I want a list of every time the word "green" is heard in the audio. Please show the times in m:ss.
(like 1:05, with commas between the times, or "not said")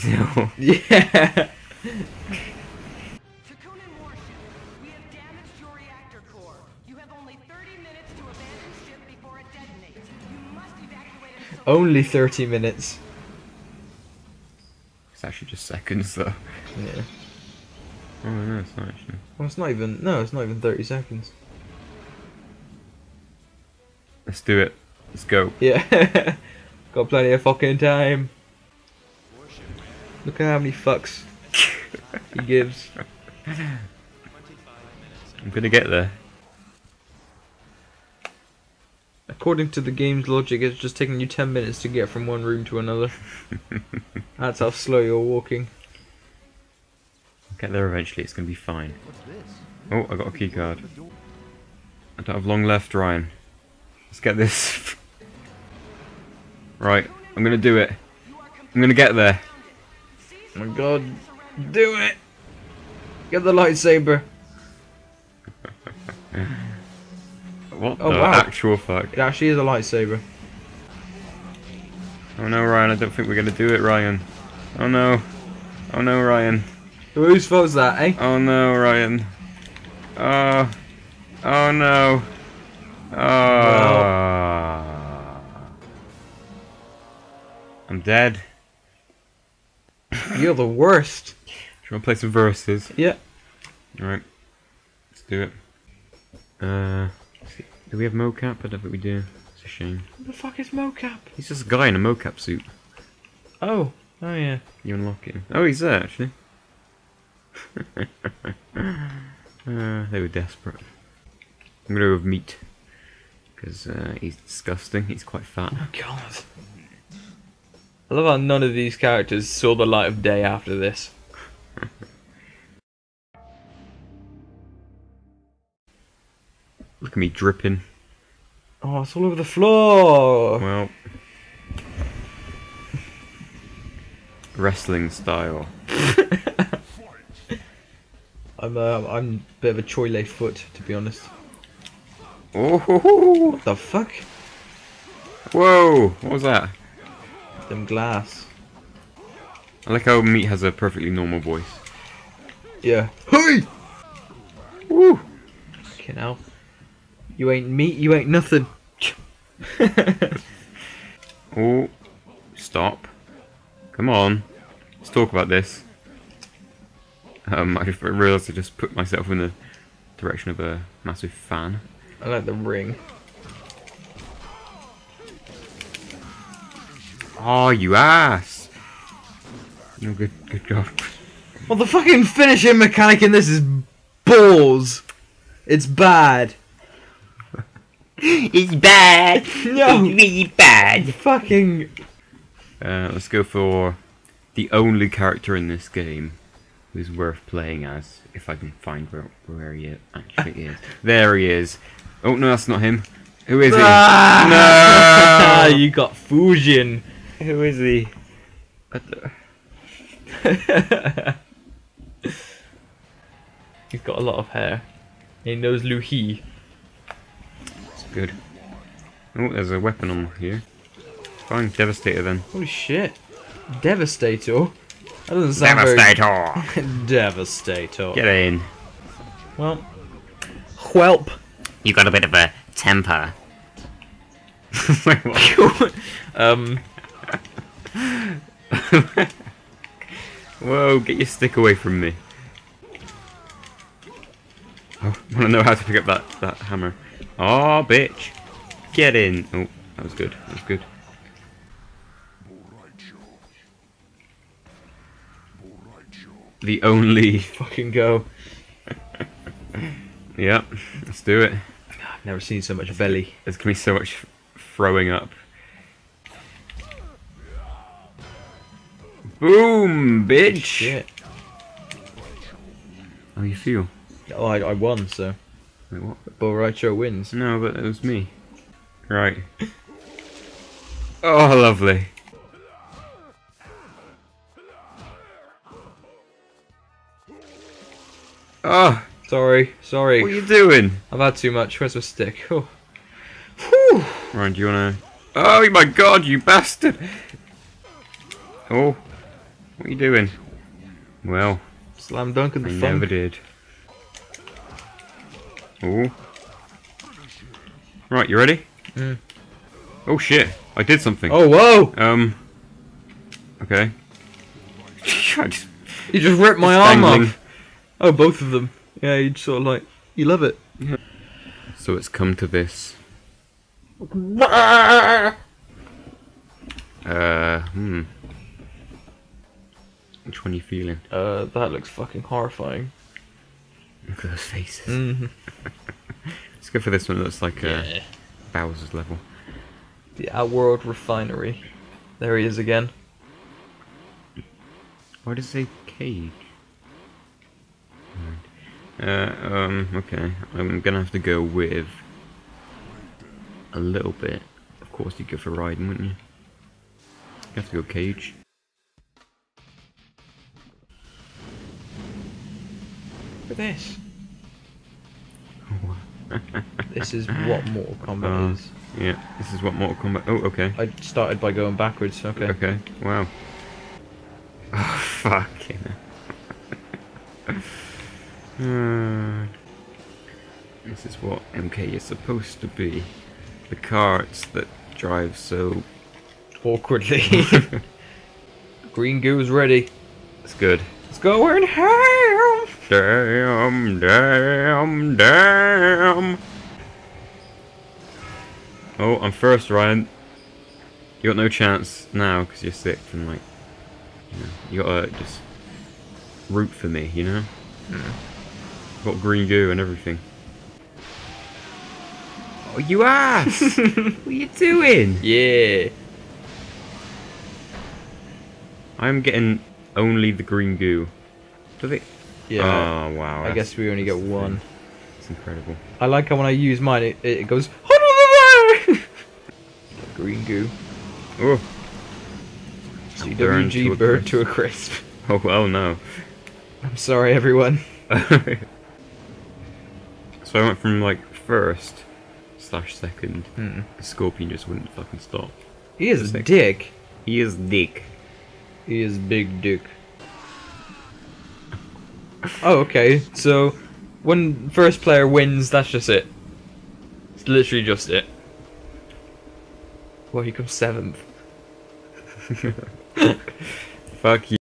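6:28, 6:49, 7:00, 7:10.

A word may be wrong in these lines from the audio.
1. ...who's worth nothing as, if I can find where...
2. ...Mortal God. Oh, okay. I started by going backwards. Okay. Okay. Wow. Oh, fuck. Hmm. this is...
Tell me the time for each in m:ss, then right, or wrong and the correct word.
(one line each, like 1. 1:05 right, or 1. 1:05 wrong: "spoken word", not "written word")
1. 3:16 wrong: "playing", not "nothing"
2. 6:09 wrong: "Kombat", not "God".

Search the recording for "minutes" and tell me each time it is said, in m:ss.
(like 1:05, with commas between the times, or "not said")
0:12, 0:41.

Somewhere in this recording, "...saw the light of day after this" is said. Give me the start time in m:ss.
1:59.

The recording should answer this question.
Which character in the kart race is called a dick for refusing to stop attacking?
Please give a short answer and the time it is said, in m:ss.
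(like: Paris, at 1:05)
Scorpion, at 7:23.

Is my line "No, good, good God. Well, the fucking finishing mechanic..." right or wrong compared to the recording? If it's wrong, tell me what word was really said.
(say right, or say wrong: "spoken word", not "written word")
right.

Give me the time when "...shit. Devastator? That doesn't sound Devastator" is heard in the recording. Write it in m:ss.
3:42.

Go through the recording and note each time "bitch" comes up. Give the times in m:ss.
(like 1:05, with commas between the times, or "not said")
4:07, 4:30.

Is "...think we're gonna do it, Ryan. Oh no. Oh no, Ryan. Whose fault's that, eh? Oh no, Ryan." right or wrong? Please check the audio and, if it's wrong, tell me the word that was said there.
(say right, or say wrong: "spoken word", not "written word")
right.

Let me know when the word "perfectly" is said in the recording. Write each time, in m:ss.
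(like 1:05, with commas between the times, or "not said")
2:30.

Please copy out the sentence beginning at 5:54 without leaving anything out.
Of course you'd go for riding, wouldn't you?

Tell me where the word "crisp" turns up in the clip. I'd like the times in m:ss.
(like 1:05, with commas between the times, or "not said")
7:14.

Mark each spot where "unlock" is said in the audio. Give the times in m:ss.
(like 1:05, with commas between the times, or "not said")
1:44.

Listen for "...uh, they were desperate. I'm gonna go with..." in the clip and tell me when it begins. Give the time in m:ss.
1:48.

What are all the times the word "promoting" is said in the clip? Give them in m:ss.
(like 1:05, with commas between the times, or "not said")
not said.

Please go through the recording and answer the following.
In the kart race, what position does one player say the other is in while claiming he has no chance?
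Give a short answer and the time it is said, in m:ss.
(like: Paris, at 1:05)
Sixth, at 6:42.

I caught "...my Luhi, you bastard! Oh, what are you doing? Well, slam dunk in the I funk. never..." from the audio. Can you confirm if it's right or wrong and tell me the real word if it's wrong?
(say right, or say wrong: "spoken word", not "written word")
wrong: "God", not "Luhi".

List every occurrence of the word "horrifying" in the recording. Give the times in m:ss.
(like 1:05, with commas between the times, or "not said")
5:32.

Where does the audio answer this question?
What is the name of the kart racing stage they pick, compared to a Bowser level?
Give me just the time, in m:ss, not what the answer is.
5:40.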